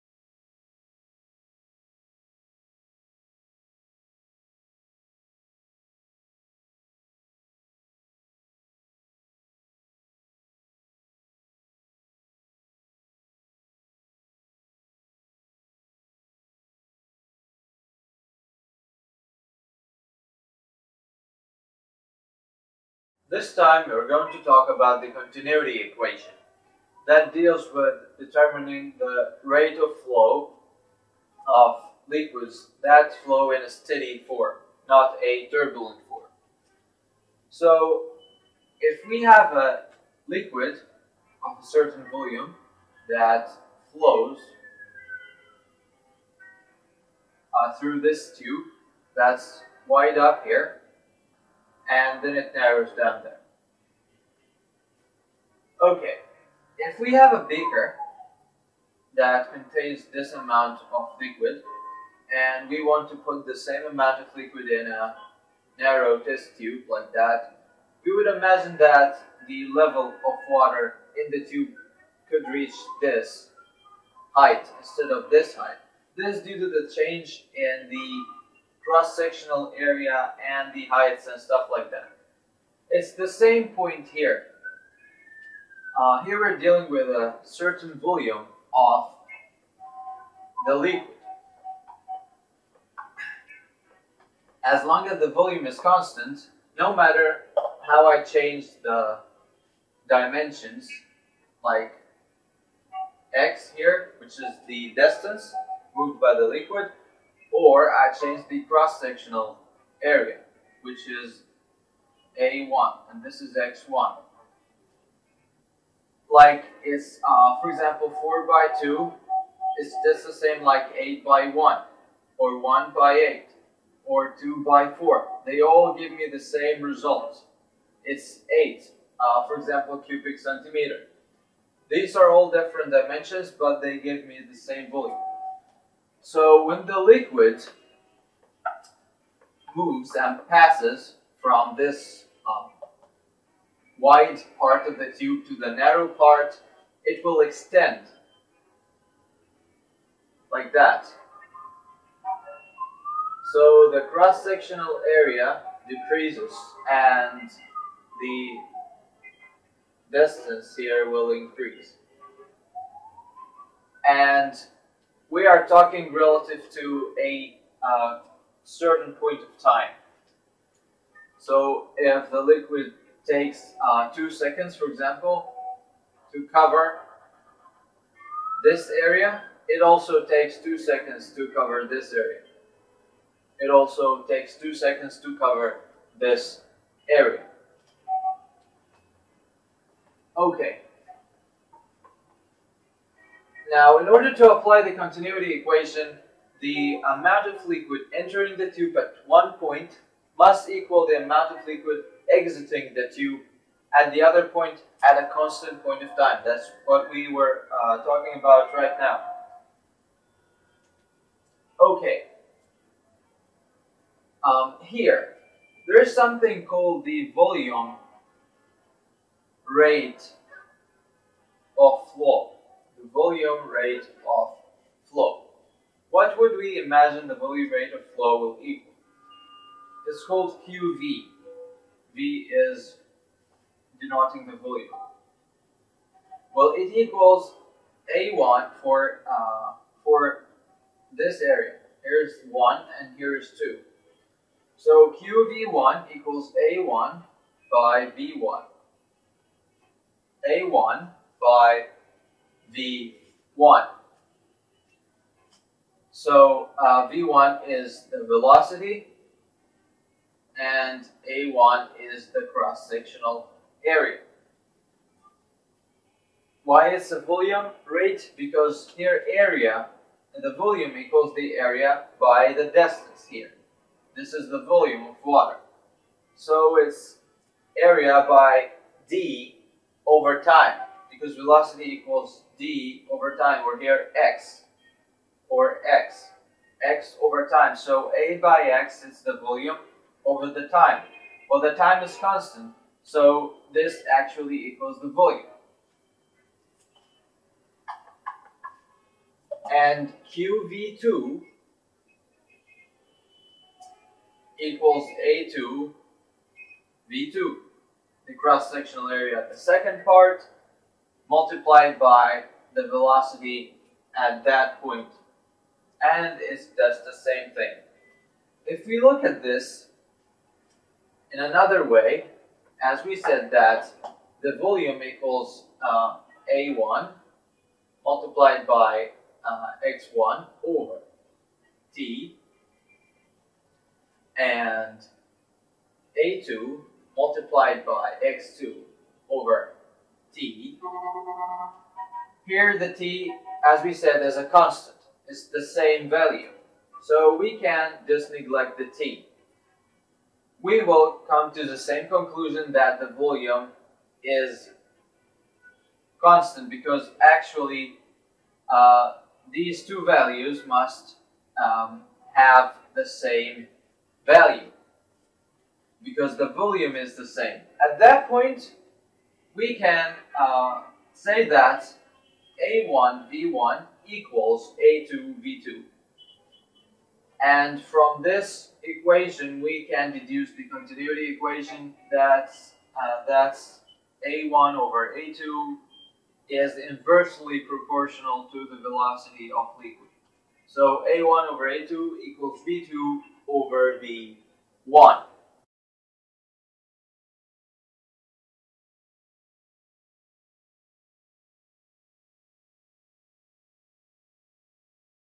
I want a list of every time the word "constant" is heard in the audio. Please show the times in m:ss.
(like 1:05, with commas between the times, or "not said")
1:35, 3:25, 4:52, 5:44, 5:56.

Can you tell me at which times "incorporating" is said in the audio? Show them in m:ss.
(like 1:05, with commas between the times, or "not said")
not said.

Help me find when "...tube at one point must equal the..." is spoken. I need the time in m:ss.
3:18.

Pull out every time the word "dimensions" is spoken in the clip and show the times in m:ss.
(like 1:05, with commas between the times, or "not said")
1:40, 2:12.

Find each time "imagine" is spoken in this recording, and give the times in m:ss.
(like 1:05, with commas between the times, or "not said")
1:08, 3:46.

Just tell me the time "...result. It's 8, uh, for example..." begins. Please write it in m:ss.
2:06.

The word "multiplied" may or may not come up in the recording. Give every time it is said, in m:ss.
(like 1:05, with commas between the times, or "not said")
5:11, 5:28, 5:37.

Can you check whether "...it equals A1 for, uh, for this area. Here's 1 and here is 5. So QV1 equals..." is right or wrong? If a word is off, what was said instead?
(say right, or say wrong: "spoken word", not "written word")
wrong: "2", not "5".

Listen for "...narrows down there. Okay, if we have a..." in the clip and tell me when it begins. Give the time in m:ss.
0:52.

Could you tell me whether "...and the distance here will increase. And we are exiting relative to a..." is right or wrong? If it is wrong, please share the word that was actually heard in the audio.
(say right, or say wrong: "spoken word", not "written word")
wrong: "talking", not "exiting".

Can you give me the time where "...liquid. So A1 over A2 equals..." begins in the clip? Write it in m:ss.
6:29.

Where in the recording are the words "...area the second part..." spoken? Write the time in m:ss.
5:09.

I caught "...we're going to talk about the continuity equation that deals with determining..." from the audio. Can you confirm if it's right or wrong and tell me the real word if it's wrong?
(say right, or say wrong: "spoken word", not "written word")
right.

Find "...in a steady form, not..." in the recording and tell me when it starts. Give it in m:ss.
0:33.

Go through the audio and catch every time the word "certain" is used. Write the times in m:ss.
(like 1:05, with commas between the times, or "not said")
0:41, 1:27, 2:48.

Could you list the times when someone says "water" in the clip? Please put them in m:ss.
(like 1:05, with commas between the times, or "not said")
1:10, 4:35.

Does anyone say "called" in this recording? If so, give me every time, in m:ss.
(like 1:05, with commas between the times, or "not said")
3:36, 3:50.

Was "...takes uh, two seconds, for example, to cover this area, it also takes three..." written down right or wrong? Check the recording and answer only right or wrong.
wrong.